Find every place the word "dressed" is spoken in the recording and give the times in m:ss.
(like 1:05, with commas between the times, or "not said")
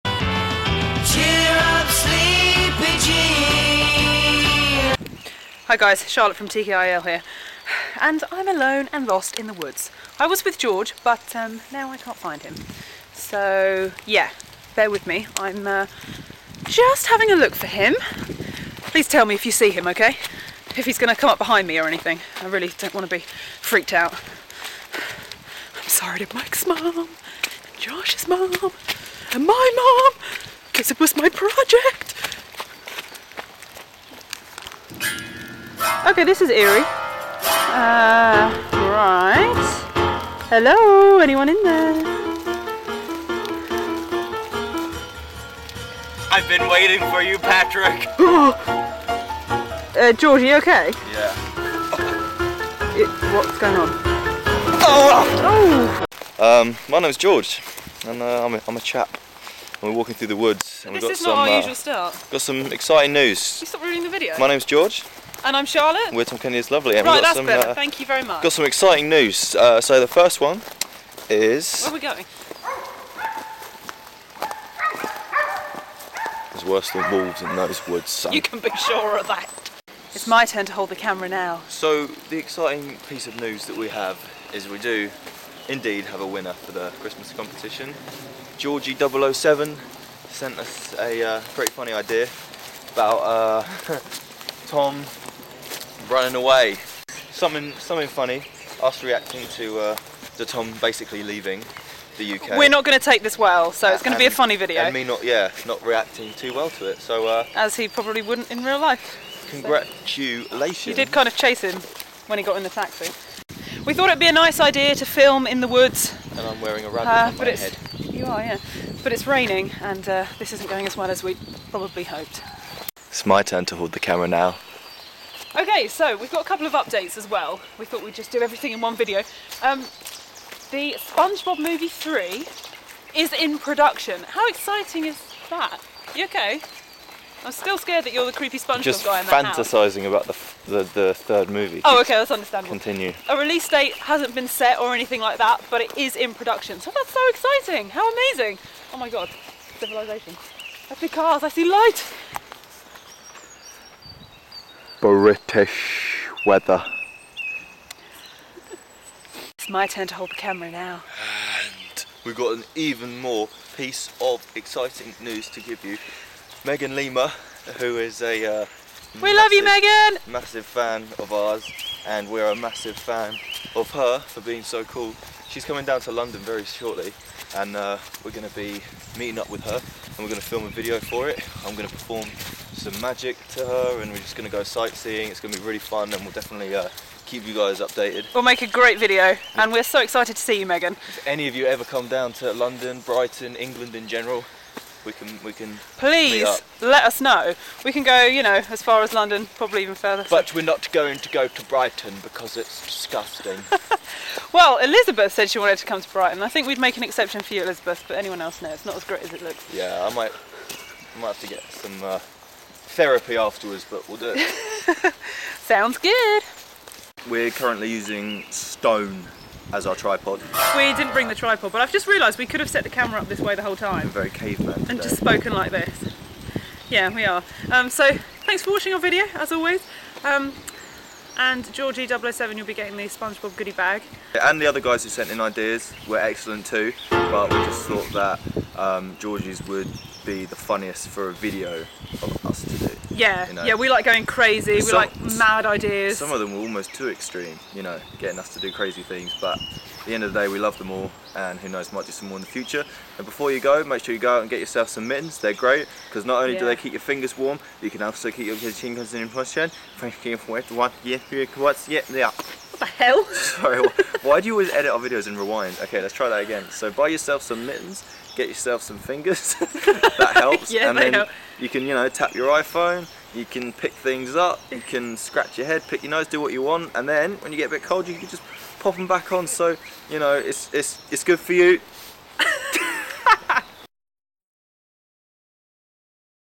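not said.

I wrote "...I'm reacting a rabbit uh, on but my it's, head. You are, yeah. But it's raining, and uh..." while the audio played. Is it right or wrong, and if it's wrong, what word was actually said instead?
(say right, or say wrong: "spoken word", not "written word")
wrong: "wearing", not "reacting".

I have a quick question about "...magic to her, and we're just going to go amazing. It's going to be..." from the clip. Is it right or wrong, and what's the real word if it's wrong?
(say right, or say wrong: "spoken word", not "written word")
wrong: "sightseeing", not "amazing".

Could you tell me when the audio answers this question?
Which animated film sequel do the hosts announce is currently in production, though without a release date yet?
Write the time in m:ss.
2:10.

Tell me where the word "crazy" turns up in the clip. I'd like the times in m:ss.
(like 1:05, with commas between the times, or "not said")
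4:04, 4:08.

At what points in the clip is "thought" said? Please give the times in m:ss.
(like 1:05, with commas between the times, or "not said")
1:53, 2:07, 3:57.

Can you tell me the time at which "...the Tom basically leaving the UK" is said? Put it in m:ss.
1:40.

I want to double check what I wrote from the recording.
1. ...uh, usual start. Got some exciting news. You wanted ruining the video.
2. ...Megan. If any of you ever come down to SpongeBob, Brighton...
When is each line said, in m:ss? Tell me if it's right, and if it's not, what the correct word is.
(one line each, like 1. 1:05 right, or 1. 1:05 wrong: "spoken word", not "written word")
1. 1:01 wrong: "stopped", not "wanted"
2. 3:10 wrong: "London", not "SpongeBob".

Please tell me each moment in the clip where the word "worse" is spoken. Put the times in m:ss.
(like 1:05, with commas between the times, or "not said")
1:16.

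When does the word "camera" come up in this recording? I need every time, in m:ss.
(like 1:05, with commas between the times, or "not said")
1:20, 2:03, 2:40, 3:42.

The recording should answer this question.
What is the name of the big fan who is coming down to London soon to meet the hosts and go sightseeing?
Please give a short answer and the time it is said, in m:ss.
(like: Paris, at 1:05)
Megan Lima, at 2:46.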